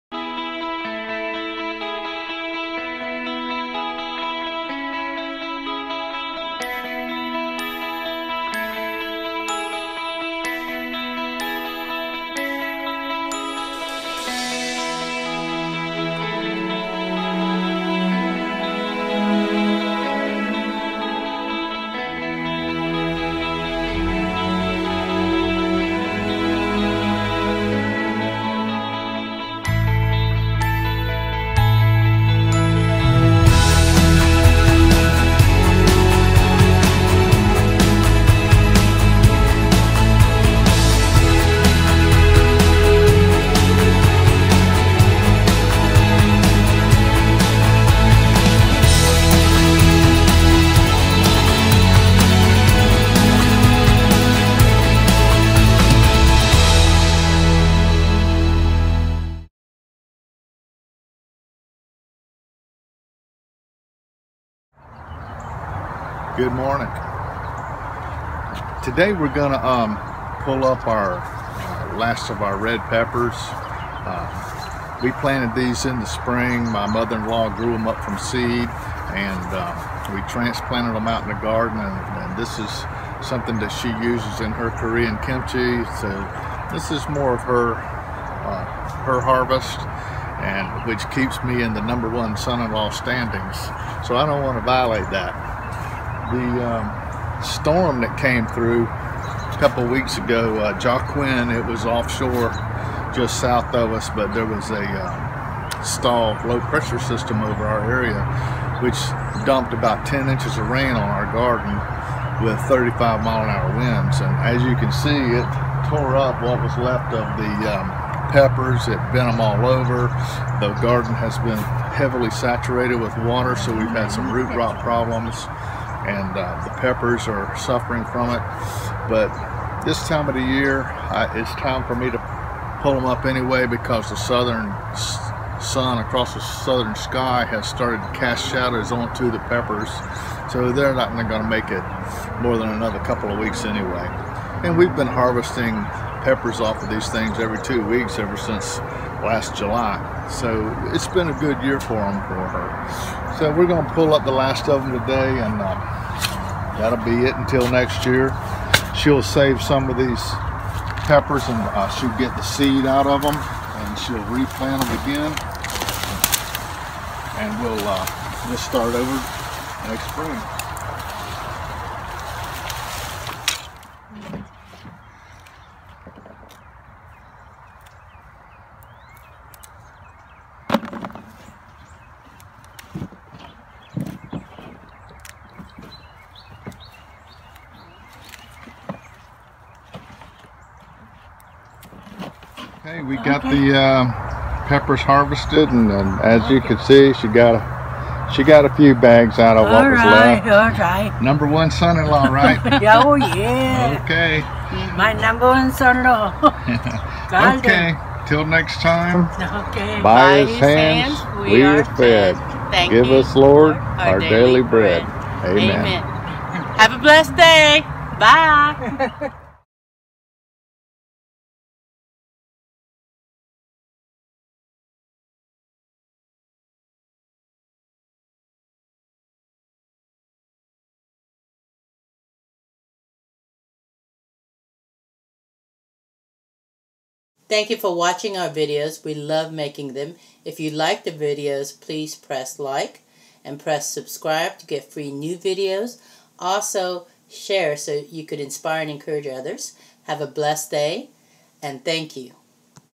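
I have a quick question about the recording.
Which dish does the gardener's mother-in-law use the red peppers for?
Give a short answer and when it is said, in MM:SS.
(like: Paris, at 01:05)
Korean kimchi, at 01:24.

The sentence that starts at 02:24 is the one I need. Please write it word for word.
And we've been harvesting peppers off of these things every two weeks ever since last July.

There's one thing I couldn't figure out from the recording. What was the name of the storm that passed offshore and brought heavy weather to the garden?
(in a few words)
Joaquin.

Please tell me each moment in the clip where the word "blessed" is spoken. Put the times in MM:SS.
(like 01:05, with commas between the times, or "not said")
03:36, 04:10.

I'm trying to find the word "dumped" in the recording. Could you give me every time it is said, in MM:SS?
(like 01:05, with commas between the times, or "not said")
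01:49.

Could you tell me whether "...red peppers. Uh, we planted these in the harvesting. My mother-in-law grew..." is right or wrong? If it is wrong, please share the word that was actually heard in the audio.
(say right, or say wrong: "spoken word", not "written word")
wrong: "spring", not "harvesting".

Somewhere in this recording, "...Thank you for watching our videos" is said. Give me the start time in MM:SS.
03:57.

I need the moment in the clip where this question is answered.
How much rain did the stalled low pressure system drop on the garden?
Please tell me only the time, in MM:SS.
01:50.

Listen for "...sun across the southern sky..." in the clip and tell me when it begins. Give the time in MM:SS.
02:15.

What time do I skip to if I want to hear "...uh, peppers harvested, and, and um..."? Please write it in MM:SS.
03:13.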